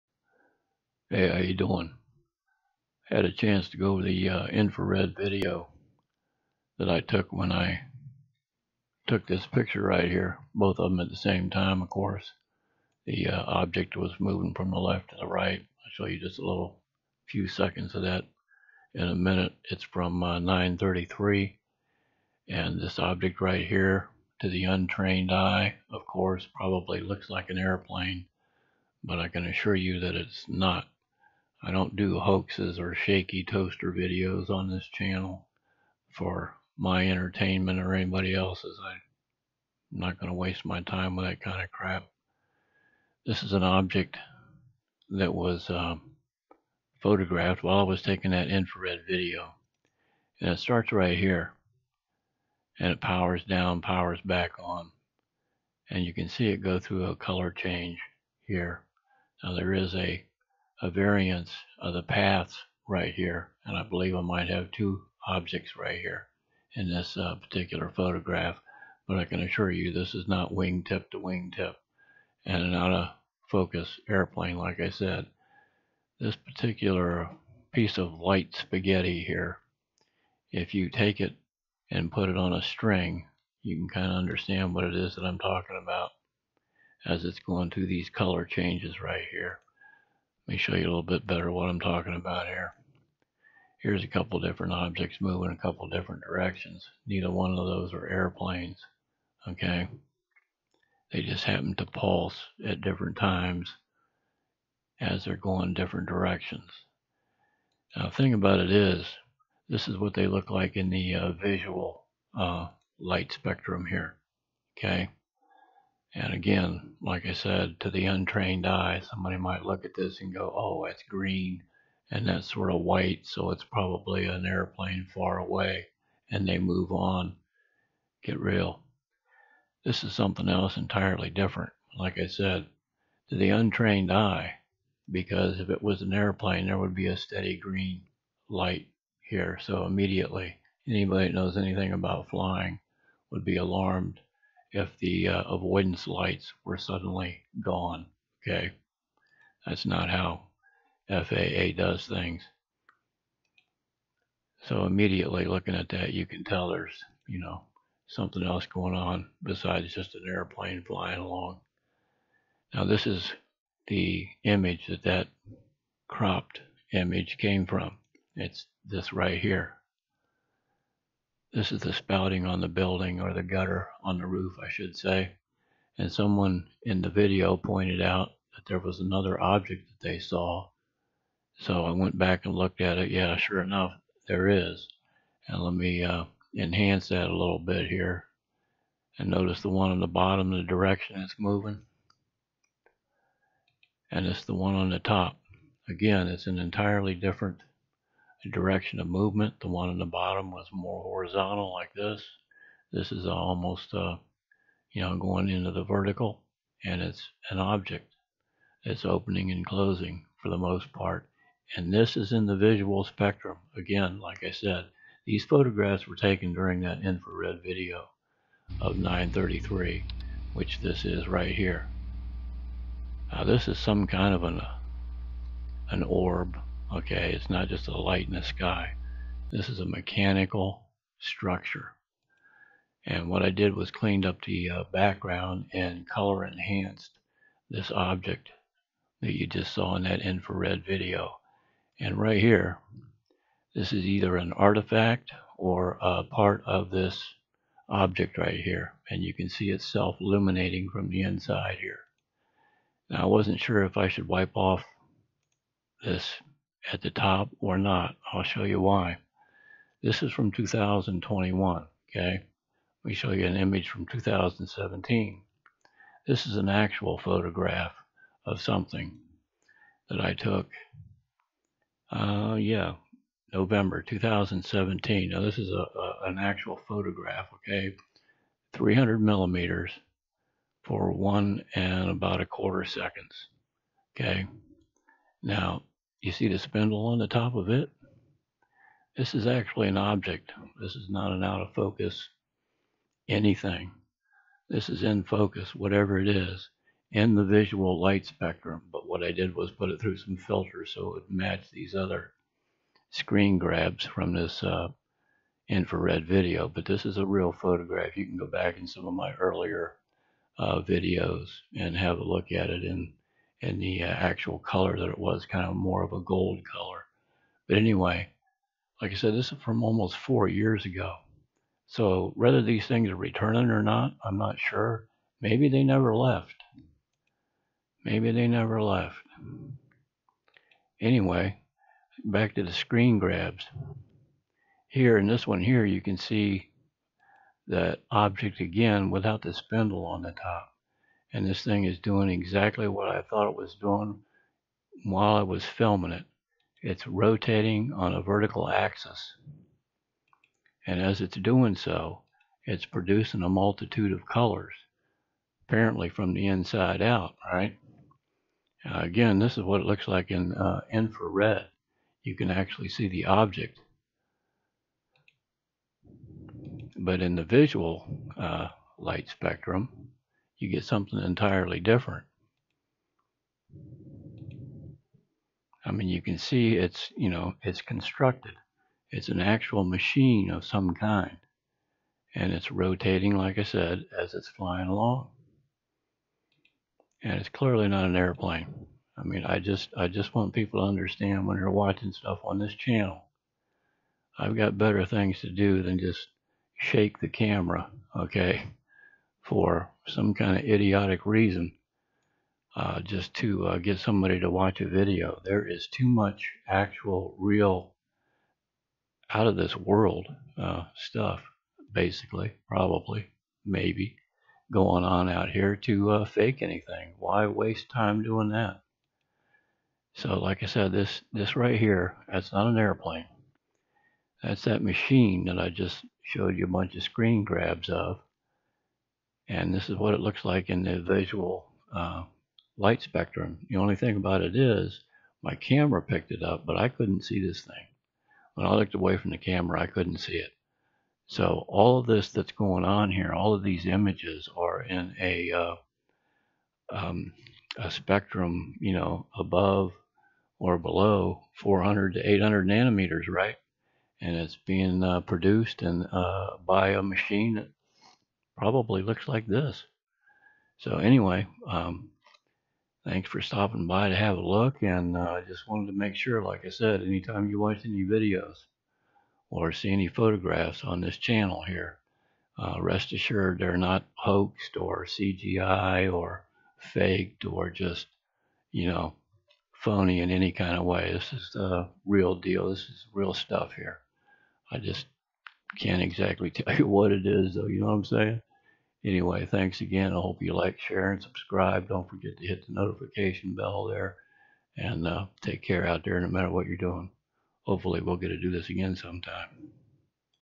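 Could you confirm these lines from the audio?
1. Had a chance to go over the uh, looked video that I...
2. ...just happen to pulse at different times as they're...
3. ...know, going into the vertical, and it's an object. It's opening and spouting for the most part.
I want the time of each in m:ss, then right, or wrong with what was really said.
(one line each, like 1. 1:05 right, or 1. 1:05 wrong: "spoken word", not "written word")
1. 0:03 wrong: "infrared", not "looked"
2. 1:41 right
3. 3:25 wrong: "closing", not "spouting".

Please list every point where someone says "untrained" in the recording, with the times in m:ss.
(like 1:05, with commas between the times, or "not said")
0:24, 1:58, 2:13.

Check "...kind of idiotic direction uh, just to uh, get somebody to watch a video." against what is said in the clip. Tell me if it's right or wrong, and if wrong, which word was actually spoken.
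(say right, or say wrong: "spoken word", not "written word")
wrong: "reason", not "direction".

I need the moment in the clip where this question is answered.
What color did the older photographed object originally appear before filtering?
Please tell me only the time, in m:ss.
5:16.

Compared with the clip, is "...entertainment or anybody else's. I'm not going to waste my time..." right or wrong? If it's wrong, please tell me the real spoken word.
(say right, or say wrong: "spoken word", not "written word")
right.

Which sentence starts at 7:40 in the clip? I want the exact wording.
So anyway, um, thanks for stopping by to have a look.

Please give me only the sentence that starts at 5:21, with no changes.
So whether these things are returning or not, I'm not sure.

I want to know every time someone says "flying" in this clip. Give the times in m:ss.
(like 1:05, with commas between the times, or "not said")
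2:22, 2:40, 6:24.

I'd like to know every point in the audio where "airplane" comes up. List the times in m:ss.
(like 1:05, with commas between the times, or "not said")
0:27, 1:14, 1:38, 2:04, 2:16, 2:40, 6:28, 7:02.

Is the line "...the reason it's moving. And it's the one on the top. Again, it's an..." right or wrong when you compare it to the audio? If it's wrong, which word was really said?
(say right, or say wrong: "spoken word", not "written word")
wrong: "direction", not "reason".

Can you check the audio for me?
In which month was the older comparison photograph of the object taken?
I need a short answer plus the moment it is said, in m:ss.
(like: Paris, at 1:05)
November, at 4:33.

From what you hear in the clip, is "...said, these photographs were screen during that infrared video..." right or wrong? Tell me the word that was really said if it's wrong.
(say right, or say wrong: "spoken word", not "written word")
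wrong: "taken", not "screen".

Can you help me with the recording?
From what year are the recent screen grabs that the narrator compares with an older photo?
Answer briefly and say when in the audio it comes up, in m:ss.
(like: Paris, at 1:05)
2021, at 4:20.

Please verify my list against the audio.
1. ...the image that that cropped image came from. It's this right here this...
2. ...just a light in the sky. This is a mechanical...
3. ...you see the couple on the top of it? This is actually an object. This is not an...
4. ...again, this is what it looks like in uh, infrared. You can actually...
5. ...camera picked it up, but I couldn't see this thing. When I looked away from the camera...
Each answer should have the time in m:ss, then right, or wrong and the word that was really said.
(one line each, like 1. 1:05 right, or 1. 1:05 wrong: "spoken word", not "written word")
1. 2:43 right
2. 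3:47 right
3. 4:46 wrong: "spindle", not "couple"
4. 5:58 right
5. 7:15 right.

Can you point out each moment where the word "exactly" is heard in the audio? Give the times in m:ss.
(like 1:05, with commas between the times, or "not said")
5:42, 8:06.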